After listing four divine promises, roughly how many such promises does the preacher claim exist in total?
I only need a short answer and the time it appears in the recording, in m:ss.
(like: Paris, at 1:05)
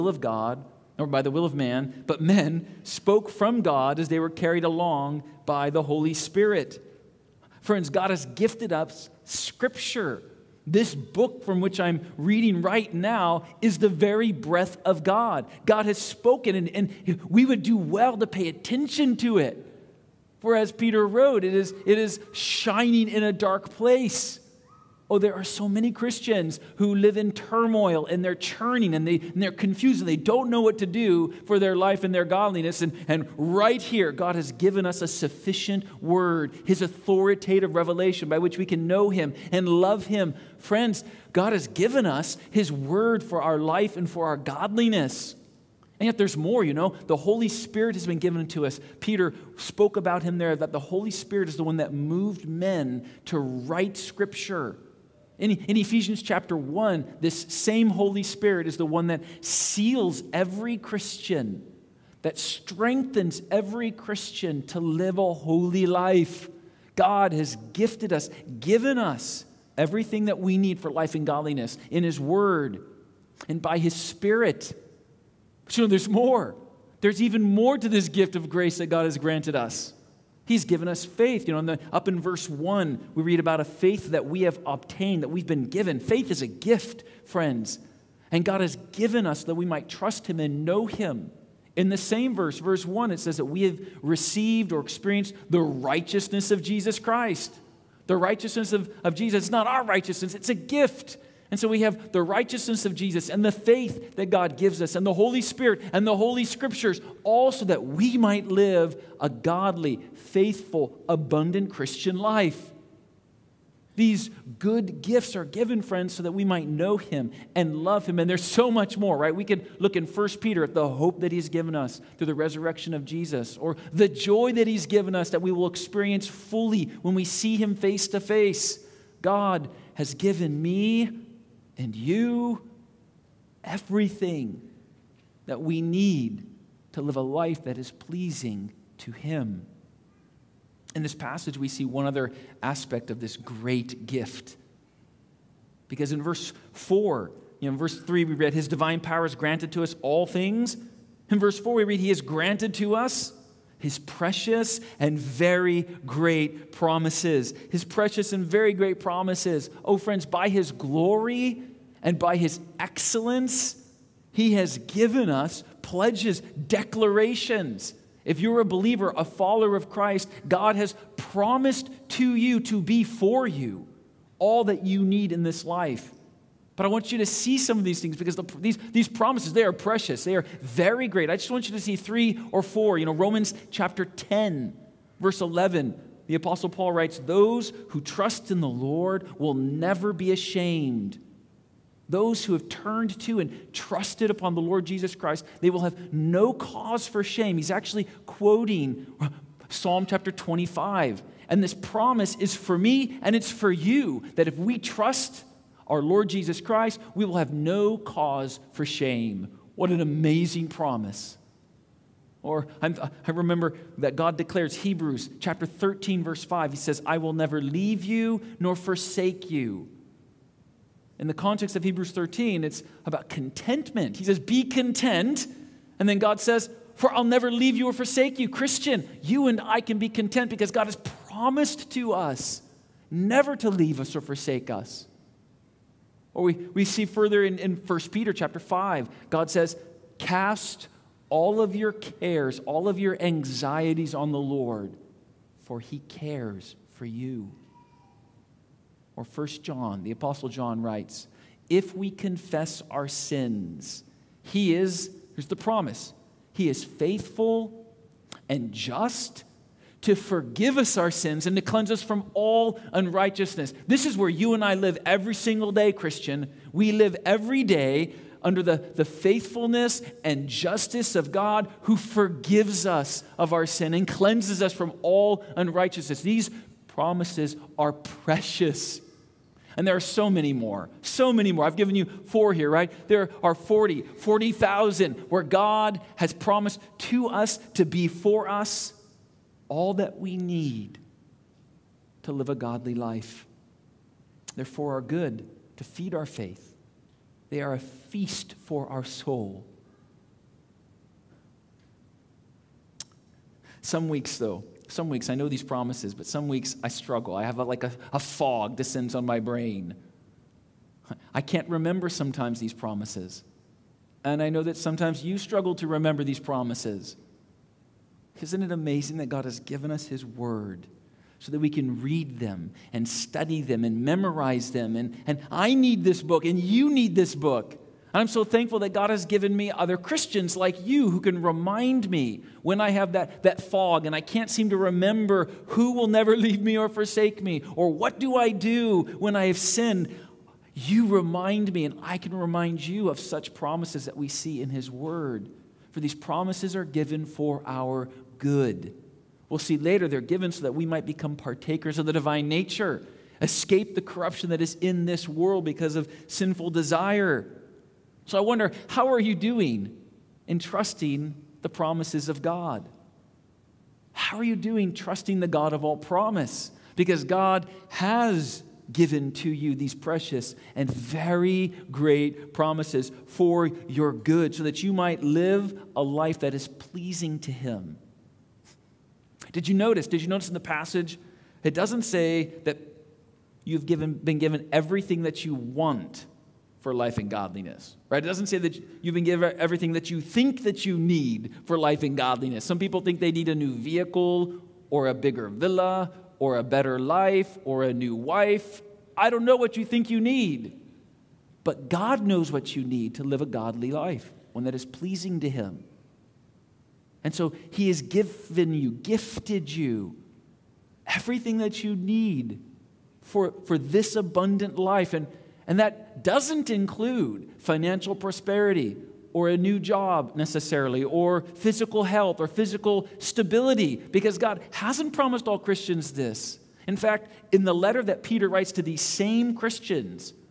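40,000, at 4:44.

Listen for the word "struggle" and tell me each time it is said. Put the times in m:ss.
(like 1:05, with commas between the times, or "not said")
5:06, 5:15.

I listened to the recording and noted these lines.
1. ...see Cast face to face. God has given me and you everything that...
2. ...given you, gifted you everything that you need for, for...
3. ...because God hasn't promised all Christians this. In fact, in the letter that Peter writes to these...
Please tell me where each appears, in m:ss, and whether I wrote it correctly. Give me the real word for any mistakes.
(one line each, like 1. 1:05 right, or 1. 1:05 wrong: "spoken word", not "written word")
1. 2:07 wrong: "Him", not "Cast"
2. 6:48 right
3. 7:03 right.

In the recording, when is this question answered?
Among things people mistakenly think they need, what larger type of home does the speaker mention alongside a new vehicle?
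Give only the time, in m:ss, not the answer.
6:35.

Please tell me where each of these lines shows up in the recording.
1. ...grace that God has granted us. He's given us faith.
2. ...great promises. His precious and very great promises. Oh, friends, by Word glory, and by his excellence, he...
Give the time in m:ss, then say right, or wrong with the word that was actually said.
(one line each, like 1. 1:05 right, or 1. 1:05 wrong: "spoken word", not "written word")
1. 1:18 right
2. 2:36 wrong: "His", not "Word".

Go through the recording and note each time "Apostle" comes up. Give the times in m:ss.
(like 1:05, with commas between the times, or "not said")
3:06, 4:10.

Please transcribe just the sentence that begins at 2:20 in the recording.
In this passage, we see one other aspect of this great gift.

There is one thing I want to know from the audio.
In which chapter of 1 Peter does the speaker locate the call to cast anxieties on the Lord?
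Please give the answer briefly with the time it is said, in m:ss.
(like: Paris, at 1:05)
Chapter 5, at 3:57.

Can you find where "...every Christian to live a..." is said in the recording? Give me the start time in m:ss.
1:03.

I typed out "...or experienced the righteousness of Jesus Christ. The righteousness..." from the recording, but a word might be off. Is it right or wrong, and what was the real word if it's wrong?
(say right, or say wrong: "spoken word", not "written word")
right.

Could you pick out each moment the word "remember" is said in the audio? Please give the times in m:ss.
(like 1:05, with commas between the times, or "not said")
3:33, 5:11, 5:15, 5:34.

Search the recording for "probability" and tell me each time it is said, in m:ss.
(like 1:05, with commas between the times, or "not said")
not said.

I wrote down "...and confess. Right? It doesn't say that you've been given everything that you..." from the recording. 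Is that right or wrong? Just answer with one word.
wrong.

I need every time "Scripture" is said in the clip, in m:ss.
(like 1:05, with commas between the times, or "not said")
0:09, 0:53, 1:46.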